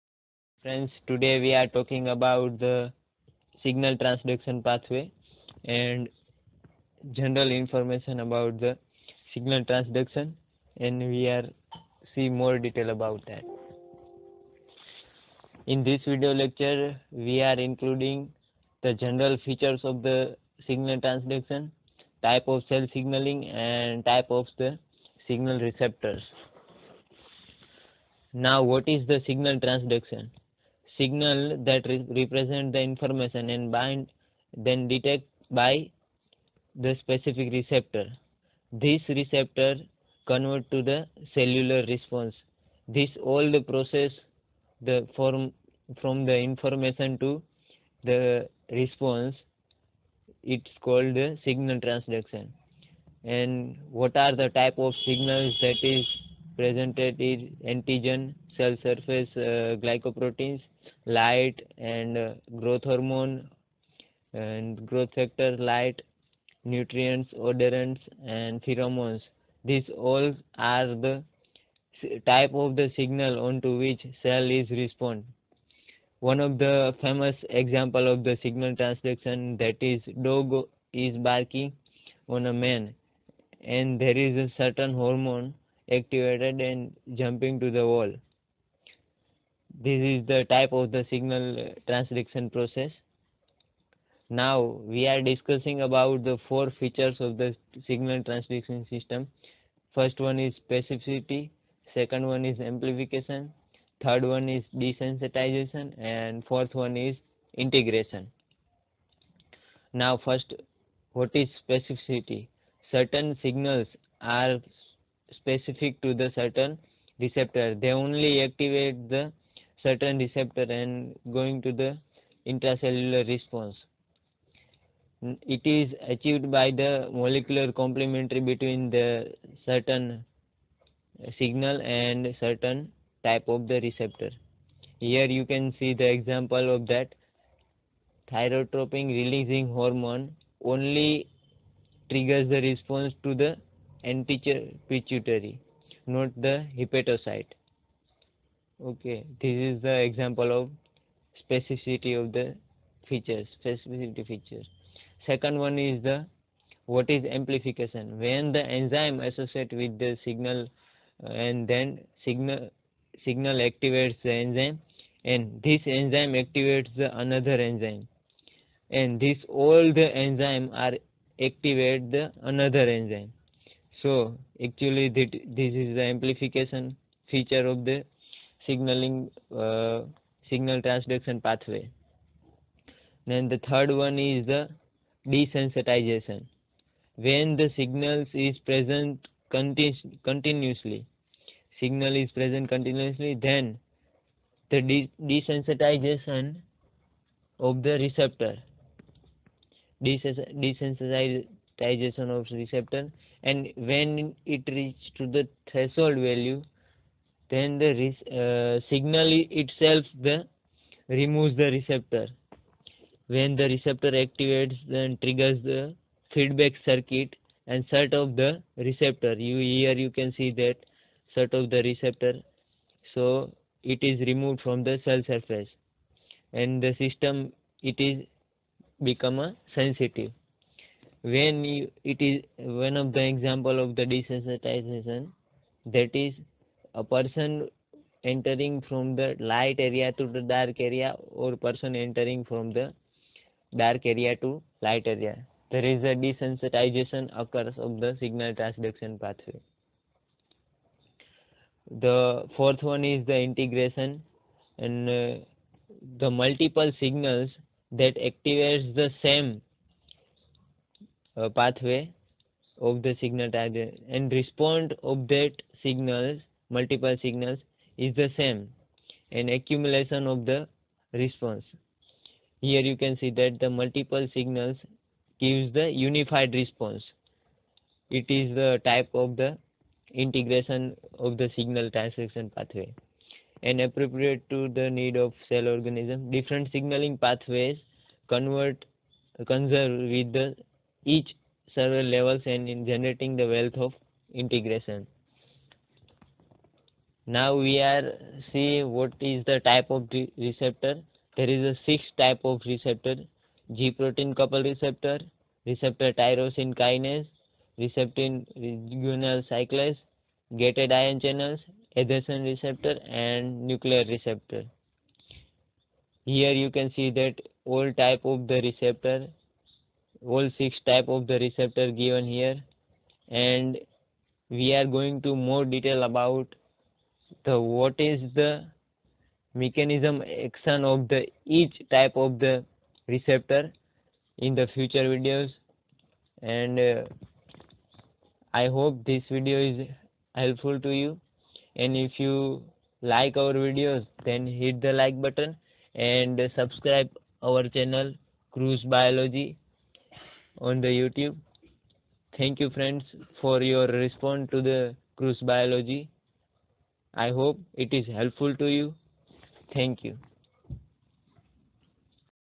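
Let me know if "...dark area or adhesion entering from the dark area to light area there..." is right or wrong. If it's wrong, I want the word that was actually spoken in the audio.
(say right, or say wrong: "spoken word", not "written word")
wrong: "person", not "adhesion".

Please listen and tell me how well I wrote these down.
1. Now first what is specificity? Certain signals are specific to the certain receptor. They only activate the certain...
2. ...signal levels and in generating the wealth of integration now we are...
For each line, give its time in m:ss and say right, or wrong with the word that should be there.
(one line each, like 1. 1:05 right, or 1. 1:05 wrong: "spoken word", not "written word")
1. 1:49 right
2. 4:51 wrong: "several", not "signal".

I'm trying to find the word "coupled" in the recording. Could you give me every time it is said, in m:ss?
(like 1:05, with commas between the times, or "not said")
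5:04.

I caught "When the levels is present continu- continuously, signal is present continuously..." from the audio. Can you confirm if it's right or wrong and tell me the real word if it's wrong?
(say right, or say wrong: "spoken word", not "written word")
wrong: "signals", not "levels".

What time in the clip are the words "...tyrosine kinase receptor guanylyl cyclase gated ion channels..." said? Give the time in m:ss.
5:06.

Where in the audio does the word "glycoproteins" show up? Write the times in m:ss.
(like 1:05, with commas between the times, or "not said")
0:59.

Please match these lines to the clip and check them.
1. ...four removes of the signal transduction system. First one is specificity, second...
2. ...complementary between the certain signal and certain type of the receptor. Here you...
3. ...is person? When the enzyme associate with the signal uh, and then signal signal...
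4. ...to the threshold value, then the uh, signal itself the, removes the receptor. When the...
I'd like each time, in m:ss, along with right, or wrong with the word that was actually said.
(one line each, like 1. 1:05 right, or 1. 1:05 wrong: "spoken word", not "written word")
1. 1:36 wrong: "features", not "removes"
2. 2:07 right
3. 2:37 wrong: "amplification", not "person"
4. 3:25 right.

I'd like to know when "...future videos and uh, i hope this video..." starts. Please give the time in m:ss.
5:34.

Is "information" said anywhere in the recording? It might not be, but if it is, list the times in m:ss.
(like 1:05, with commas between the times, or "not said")
0:07, 0:32, 0:46.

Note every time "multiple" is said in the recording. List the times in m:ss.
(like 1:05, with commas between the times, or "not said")
4:16, 4:26, 4:33.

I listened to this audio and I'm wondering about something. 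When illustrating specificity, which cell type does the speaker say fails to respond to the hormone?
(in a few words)
Hepatocyte.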